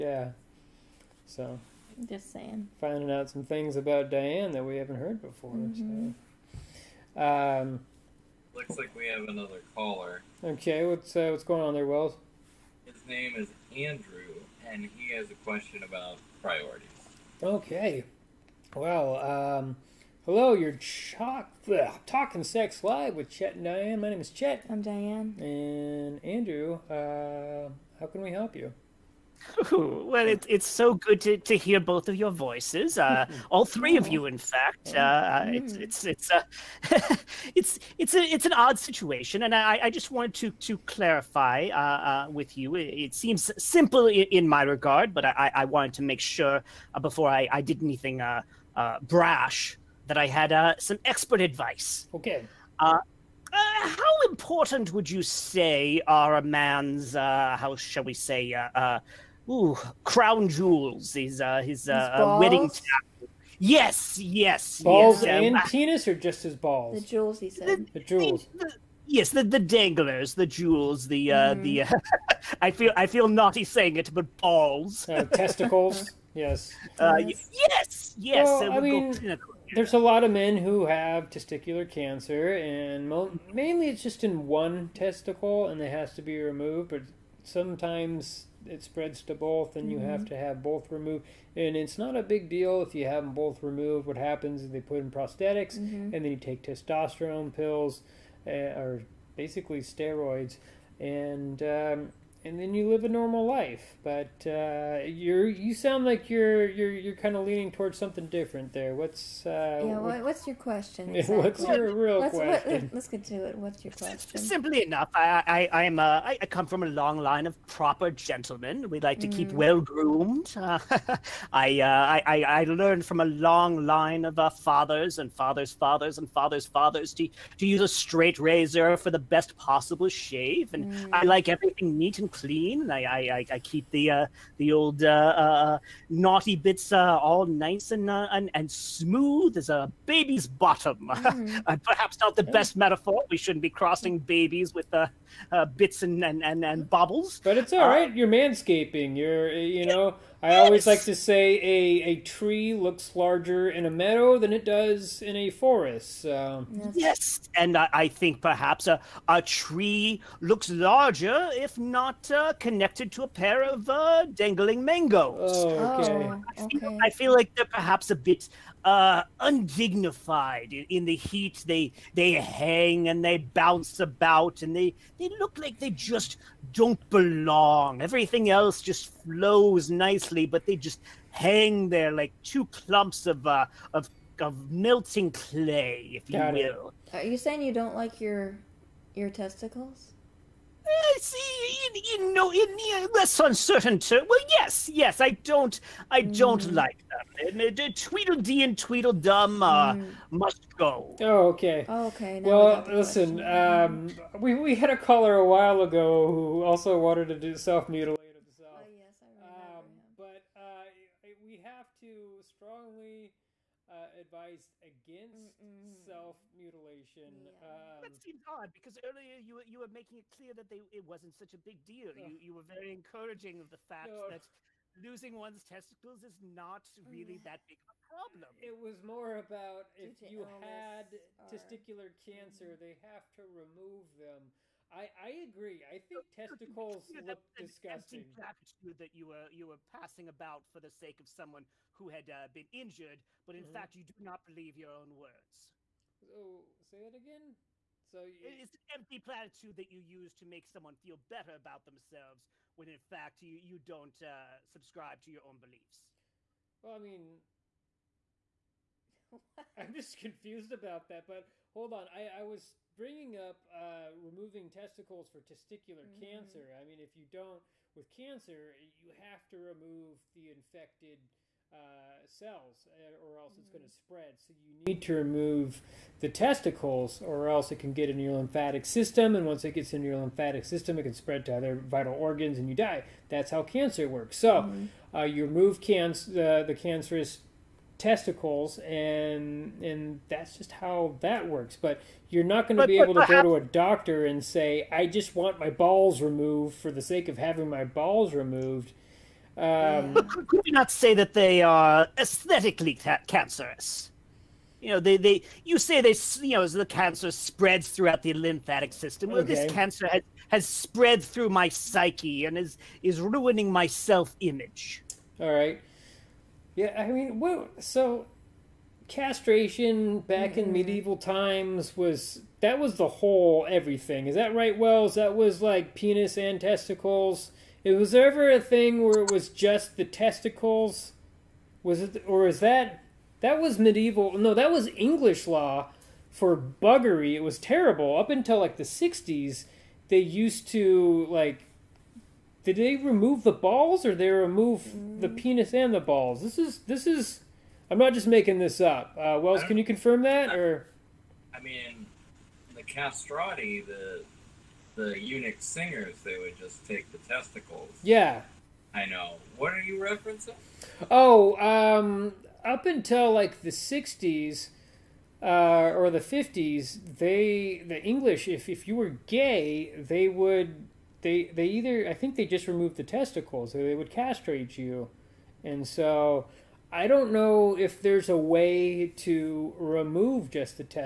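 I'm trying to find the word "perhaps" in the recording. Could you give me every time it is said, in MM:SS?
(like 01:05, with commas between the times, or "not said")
02:21, 02:38, 02:47, 04:53.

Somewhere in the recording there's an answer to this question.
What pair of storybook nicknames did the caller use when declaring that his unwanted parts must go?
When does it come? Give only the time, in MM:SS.
03:17.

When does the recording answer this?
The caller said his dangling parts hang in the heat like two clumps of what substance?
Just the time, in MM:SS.
03:04.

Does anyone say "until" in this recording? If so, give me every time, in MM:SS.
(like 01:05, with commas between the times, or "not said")
05:38, 06:02.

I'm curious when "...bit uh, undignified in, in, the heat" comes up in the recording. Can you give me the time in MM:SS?
02:48.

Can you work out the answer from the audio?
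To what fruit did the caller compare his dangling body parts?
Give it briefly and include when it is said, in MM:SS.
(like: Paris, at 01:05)
mangoes, at 02:44.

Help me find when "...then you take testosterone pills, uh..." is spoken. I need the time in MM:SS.
01:36.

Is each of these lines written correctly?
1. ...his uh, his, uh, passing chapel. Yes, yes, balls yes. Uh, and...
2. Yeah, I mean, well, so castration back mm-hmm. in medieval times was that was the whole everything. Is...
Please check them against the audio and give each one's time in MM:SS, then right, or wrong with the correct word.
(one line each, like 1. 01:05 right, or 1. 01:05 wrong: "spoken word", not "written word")
1. 01:01 wrong: "wedding", not "passing"
2. 05:16 right.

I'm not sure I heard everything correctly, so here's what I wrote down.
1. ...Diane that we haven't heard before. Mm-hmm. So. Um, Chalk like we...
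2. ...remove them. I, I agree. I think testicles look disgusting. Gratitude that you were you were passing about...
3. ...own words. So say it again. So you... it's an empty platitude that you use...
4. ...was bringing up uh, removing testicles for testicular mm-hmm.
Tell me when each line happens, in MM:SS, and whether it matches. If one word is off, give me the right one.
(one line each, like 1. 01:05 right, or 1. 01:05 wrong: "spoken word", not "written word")
1. 00:04 wrong: "Looks", not "Chalk"
2. 03:53 right
3. 04:04 right
4. 04:22 right.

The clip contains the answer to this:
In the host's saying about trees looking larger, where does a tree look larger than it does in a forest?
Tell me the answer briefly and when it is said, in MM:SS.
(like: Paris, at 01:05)
in a meadow, at 02:33.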